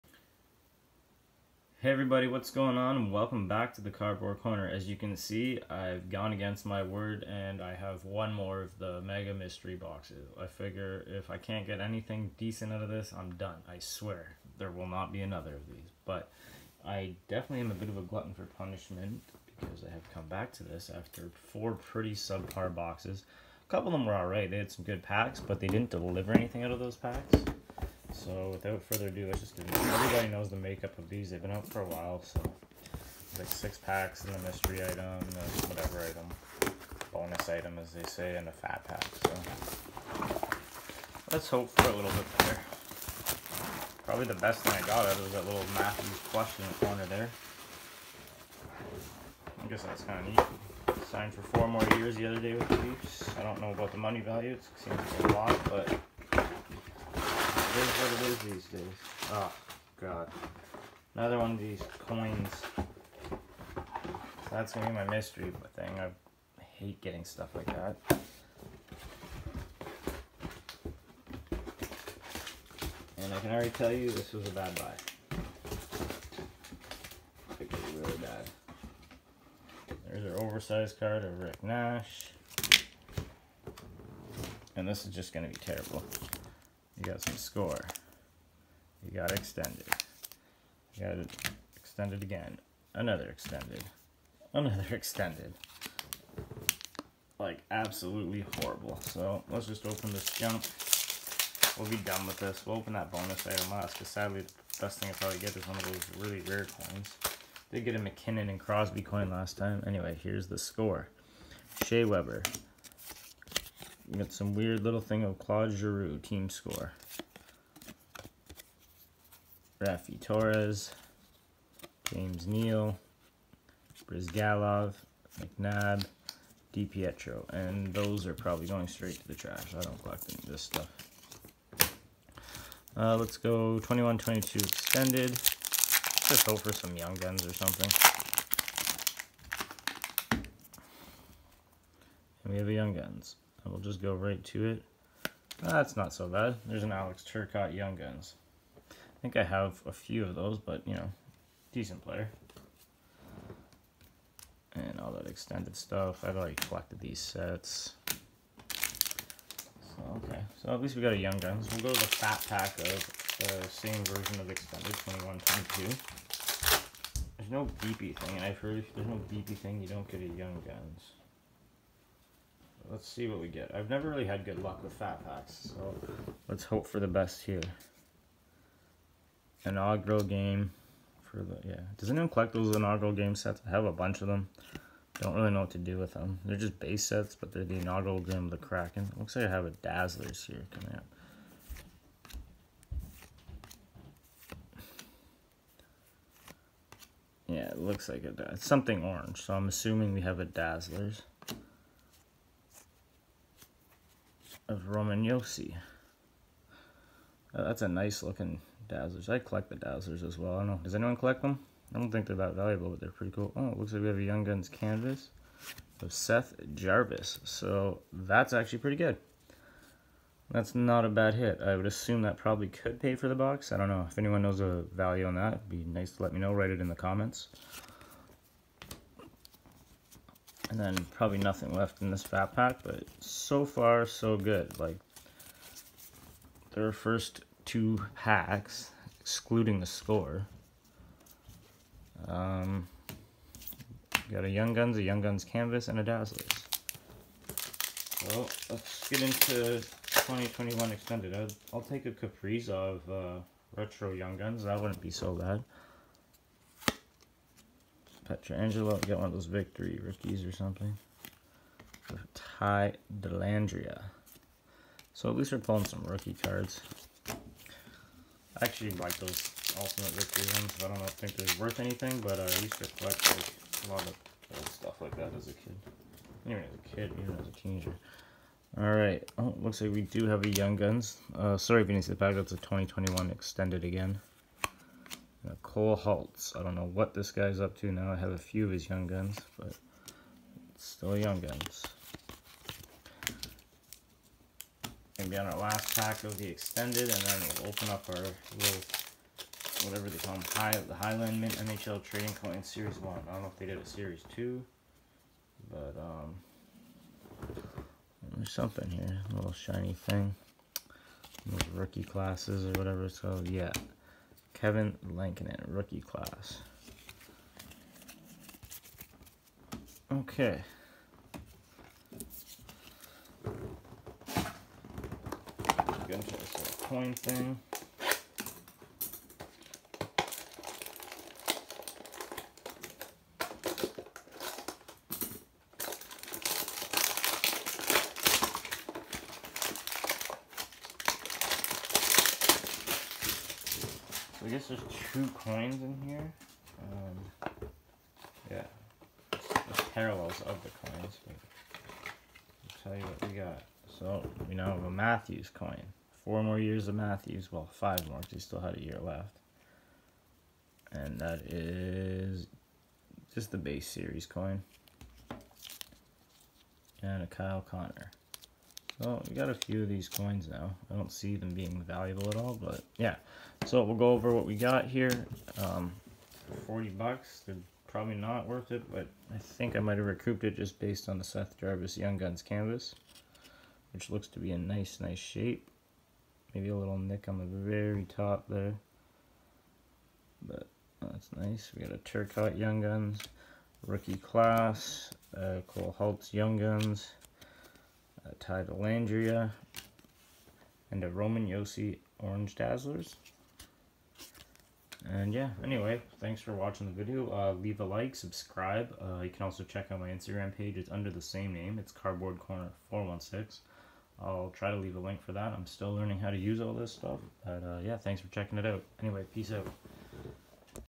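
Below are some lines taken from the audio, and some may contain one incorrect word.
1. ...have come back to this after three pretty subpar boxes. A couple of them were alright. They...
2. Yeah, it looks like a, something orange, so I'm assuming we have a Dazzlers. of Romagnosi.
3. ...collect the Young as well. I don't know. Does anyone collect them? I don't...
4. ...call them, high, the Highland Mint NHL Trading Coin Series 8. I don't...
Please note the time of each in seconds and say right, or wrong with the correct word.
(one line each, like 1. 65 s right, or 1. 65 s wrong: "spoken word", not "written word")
1. 19 s wrong: "four", not "three"
2. 197 s right
3. 209 s wrong: "Dowsers", not "Young"
4. 300 s wrong: "1", not "8".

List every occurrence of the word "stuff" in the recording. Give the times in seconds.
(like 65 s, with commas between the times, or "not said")
67 s, 130 s, 155 s, 274 s, 416 s.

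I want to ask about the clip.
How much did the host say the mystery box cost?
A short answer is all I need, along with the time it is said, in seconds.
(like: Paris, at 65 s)
$40, at 376 s.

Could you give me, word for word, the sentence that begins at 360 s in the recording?
And that is just the base series coin.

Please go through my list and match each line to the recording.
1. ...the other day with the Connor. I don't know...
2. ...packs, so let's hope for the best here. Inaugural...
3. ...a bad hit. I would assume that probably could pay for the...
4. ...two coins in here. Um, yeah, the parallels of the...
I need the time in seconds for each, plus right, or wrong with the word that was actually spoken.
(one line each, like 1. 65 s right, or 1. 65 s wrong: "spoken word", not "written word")
1. 52 s wrong: "Leafs", not "Connor"
2. 175 s right
3. 221 s right
4. 345 s right.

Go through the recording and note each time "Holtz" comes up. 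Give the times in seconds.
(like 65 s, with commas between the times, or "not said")
285 s, 395 s.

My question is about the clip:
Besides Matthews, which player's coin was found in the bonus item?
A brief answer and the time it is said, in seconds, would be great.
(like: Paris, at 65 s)
Kyle Connor, at 367 s.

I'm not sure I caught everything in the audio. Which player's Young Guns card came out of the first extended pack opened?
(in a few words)
Alex Turcotte.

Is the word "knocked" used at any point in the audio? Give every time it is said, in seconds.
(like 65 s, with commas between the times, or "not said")
not said.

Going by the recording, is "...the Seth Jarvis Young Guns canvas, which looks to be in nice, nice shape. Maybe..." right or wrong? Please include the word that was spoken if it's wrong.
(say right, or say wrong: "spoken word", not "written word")
right.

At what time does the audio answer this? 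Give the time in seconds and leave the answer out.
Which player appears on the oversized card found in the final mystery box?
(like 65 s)
81 s.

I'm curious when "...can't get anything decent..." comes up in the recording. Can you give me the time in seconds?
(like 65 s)
11 s.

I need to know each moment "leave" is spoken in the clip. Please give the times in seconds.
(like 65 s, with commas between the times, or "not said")
407 s, 414 s.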